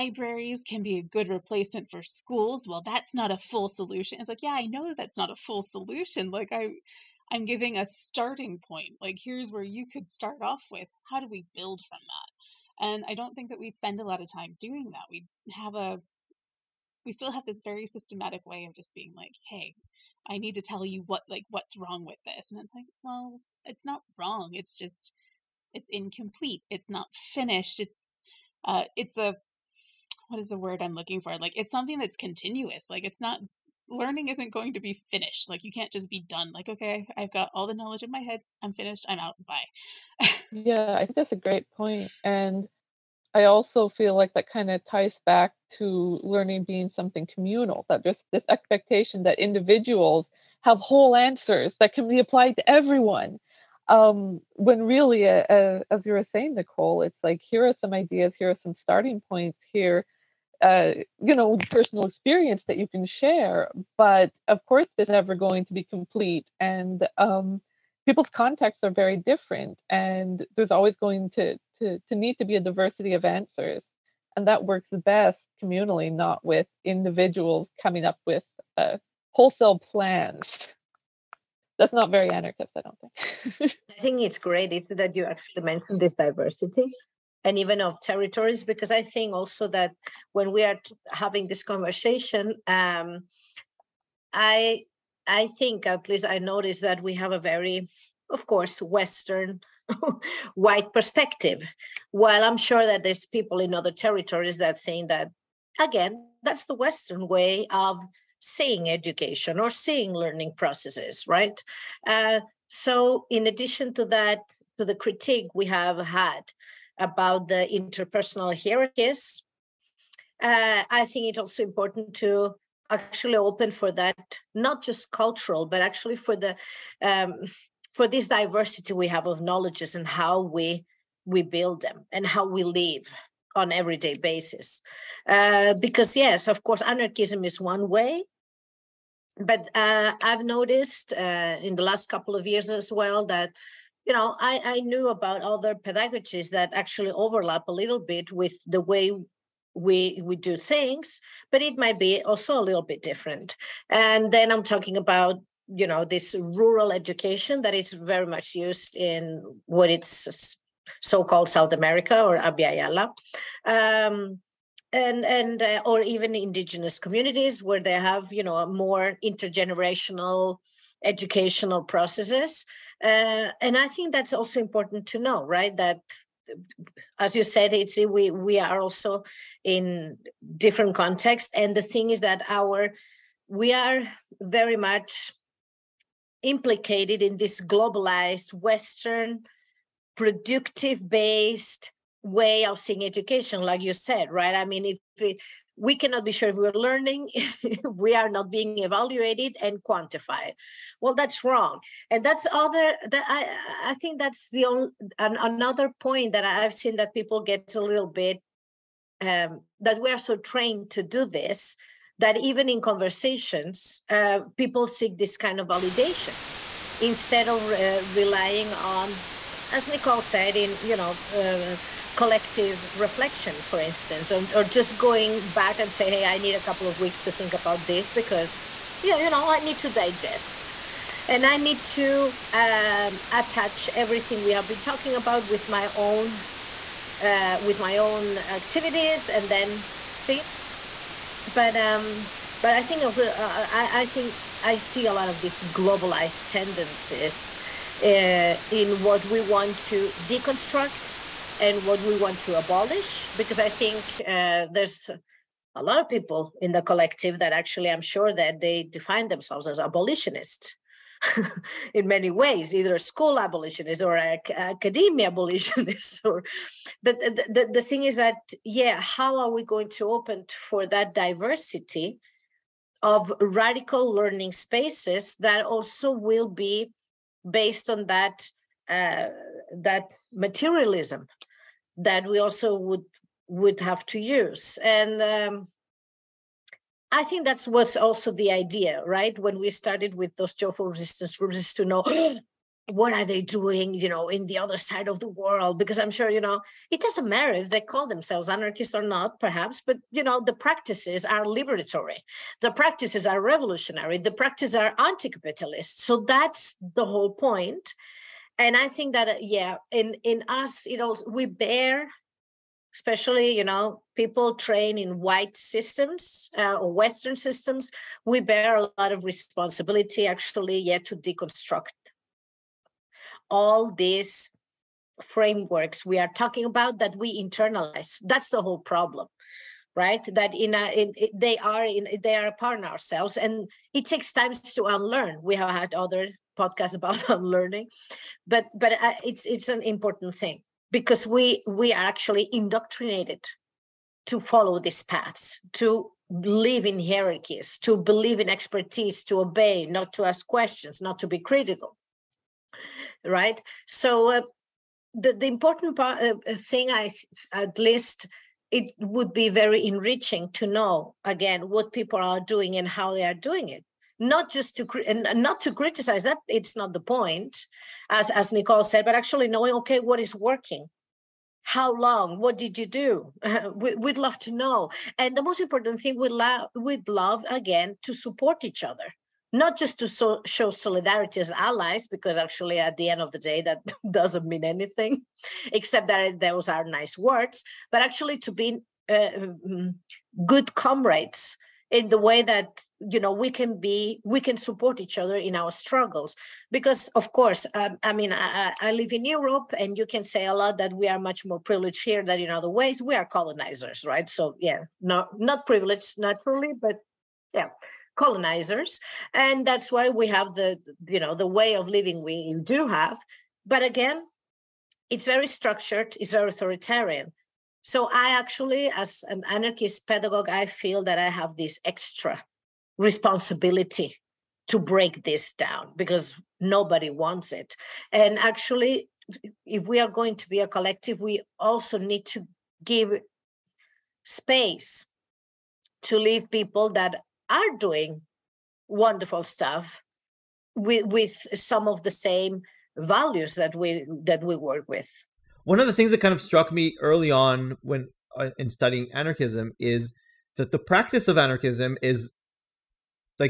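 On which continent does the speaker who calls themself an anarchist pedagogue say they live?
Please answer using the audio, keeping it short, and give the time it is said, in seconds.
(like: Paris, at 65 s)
Europe, at 399 s.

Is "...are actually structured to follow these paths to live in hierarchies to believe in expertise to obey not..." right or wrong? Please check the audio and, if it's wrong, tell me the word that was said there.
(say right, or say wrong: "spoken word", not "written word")
wrong: "indoctrinated", not "structured".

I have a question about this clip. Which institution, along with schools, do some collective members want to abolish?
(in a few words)
Academia.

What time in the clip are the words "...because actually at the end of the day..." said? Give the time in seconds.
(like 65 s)
382 s.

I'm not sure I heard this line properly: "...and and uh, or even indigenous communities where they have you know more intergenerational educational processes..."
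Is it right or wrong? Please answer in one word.
right.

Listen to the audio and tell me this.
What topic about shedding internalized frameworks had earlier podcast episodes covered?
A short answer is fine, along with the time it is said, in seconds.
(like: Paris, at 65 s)
Unlearning, at 337 s.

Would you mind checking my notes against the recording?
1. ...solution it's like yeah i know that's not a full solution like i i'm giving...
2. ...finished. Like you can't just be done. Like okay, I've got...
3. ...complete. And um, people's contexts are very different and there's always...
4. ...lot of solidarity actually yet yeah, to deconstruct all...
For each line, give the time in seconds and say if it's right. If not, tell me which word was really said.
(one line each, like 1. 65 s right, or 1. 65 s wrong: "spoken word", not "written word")
1. 3 s right
2. 35 s right
3. 65 s right
4. 318 s wrong: "responsibility", not "solidarity".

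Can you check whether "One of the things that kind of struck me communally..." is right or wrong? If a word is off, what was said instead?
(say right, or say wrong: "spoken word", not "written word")
wrong: "early", not "communally".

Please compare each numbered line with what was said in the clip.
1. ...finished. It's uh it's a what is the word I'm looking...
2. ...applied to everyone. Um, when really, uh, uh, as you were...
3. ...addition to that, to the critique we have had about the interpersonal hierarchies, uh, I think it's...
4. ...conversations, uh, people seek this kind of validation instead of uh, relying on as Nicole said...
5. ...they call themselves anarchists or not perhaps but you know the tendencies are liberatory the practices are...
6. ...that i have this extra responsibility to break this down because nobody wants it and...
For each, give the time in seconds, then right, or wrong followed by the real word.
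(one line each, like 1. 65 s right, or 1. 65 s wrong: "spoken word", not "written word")
1. 27 s right
2. 52 s right
3. 113 s right
4. 212 s right
5. 297 s wrong: "practices", not "tendencies"
6. 421 s right.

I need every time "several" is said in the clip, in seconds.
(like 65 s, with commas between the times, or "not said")
not said.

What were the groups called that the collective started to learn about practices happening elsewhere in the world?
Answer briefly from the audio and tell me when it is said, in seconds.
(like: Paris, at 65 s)
Joyful resistance groups, at 290 s.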